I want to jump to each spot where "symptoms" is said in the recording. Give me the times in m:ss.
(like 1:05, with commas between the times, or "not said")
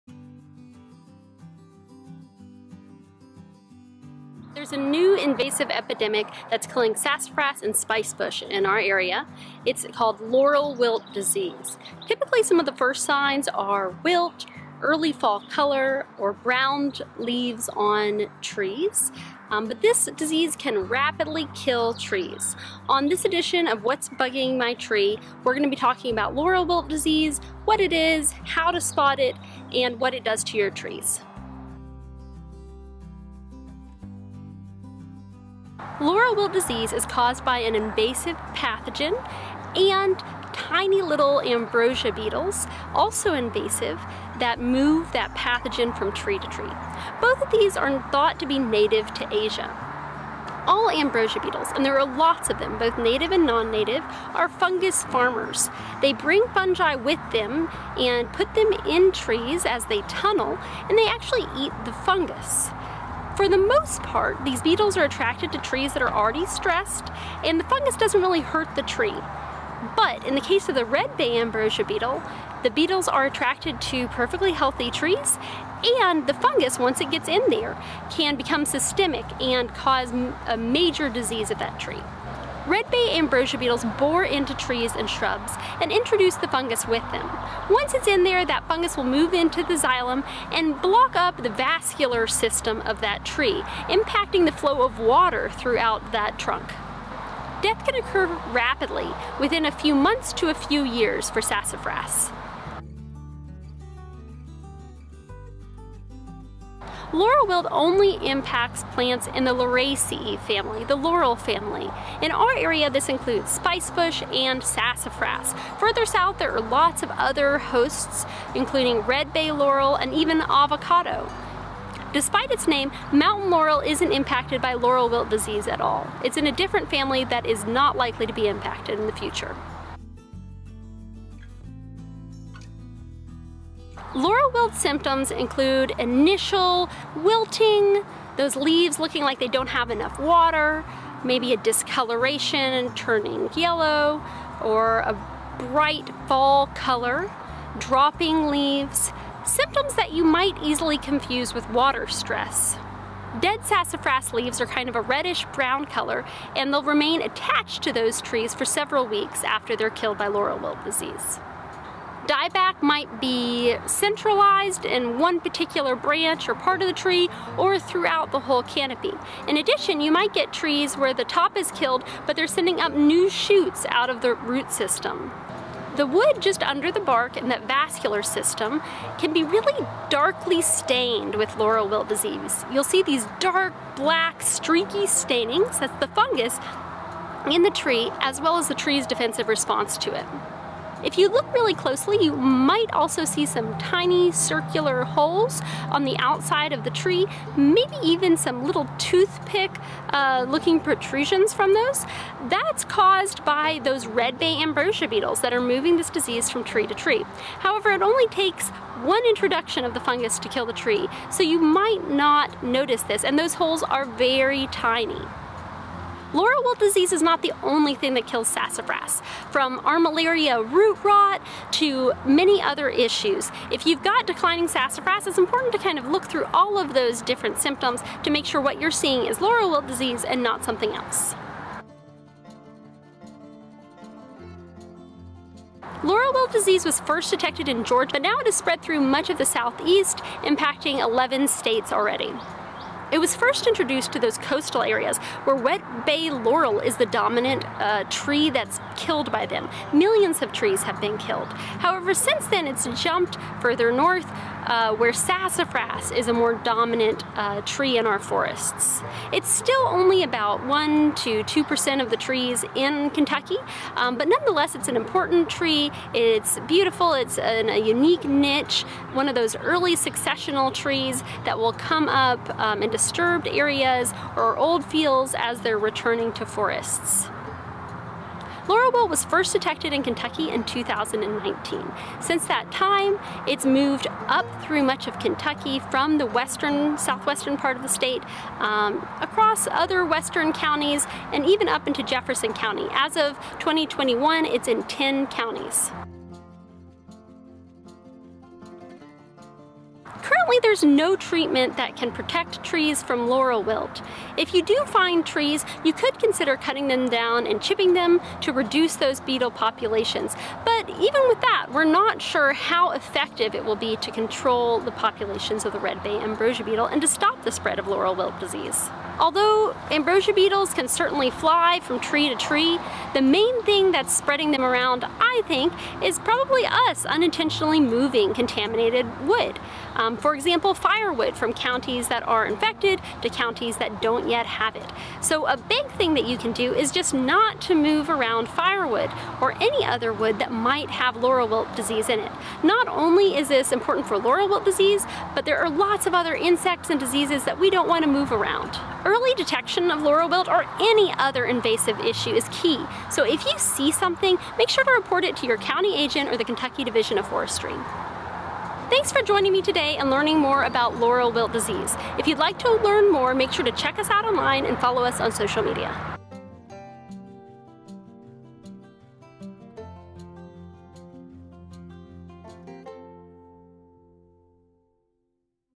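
2:14, 2:29, 3:47.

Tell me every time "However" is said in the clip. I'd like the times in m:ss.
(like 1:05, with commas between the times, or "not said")
3:27, 4:11.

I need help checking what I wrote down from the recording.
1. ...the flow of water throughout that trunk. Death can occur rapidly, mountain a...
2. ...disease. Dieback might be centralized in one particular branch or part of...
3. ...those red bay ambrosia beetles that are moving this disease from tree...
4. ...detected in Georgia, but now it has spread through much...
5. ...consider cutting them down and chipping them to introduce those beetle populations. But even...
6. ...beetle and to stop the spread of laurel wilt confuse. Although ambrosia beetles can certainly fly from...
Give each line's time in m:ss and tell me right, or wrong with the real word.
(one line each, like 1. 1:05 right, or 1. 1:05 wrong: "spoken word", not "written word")
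1. 1:34 wrong: "within", not "mountain"
2. 2:40 right
3. 3:23 right
4. 3:57 right
5. 5:06 wrong: "reduce", not "introduce"
6. 5:16 wrong: "disease", not "confuse".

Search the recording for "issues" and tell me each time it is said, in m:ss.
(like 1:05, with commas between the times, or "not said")
3:42, 5:51.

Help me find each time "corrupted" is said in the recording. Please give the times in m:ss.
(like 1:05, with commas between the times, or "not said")
not said.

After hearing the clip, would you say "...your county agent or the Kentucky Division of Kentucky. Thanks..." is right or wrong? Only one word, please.
wrong.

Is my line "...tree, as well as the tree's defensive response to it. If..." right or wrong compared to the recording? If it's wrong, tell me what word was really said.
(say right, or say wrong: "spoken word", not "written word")
right.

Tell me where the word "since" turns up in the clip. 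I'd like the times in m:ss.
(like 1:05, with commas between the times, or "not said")
4:12, 4:42.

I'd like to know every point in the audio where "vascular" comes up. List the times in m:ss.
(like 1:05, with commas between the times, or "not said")
1:31, 2:57.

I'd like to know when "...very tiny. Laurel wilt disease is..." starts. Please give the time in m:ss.
3:34.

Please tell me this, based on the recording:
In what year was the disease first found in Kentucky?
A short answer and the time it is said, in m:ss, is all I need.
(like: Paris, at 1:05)
2019, at 4:40.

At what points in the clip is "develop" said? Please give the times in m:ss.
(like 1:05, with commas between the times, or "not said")
not said.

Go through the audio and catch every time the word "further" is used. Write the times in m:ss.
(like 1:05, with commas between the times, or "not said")
1:55, 4:13.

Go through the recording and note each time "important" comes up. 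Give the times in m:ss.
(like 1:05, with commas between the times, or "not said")
3:45, 4:24, 5:43.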